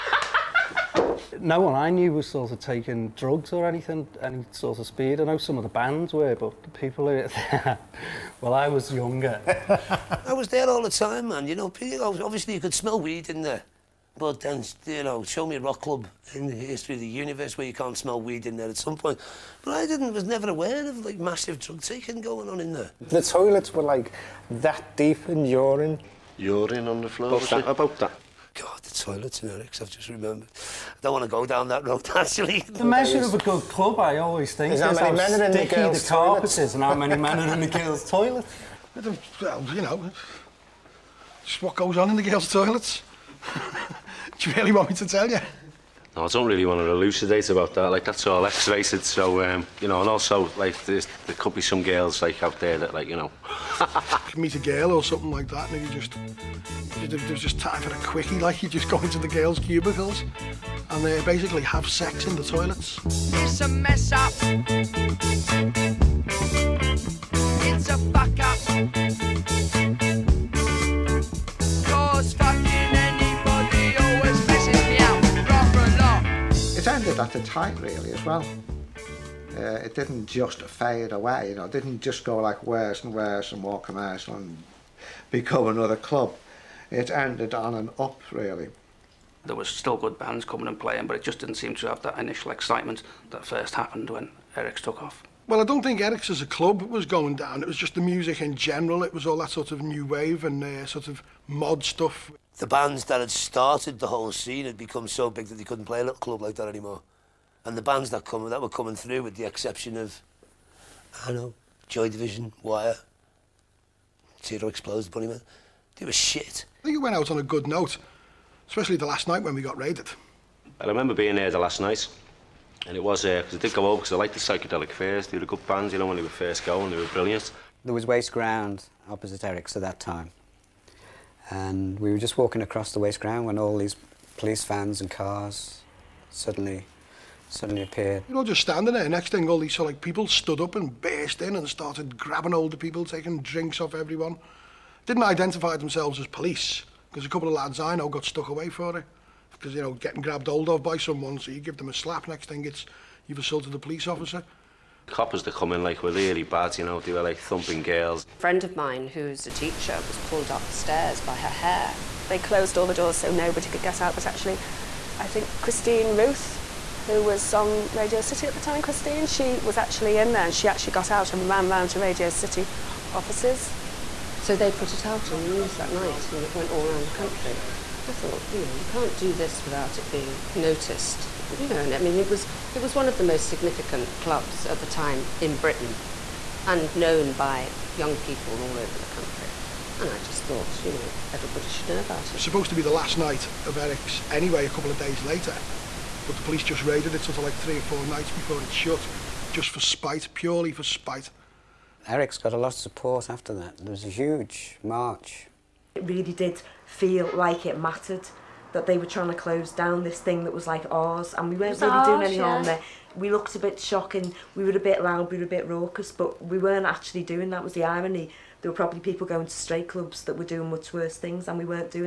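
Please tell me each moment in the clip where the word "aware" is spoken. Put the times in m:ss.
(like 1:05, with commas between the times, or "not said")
0:20.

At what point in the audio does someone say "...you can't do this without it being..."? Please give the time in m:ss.
2:58.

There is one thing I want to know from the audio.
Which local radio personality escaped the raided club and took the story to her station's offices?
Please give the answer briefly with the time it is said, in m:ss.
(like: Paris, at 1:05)
Christine Ruth, at 2:45.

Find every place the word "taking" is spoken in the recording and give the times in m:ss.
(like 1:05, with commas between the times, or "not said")
0:02, 0:21, 2:23.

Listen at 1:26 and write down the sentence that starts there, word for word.
It ended on and up really.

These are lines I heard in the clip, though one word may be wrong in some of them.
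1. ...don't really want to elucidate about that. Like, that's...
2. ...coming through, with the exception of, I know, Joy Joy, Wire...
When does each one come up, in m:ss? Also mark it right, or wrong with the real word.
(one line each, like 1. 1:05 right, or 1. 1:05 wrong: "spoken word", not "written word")
1. 0:46 right
2. 1:48 wrong: "Division", not "Joy".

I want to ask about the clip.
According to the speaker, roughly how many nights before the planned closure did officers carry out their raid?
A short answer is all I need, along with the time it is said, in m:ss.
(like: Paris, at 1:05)
3 or 4 nights, at 3:17.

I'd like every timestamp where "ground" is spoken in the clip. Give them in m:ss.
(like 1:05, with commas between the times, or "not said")
2:08, 2:13.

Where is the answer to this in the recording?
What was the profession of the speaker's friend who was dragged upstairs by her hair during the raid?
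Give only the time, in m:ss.
2:39.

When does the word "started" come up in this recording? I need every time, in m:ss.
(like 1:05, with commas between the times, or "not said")
1:43, 2:21.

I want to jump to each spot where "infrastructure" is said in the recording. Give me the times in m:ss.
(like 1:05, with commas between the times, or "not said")
not said.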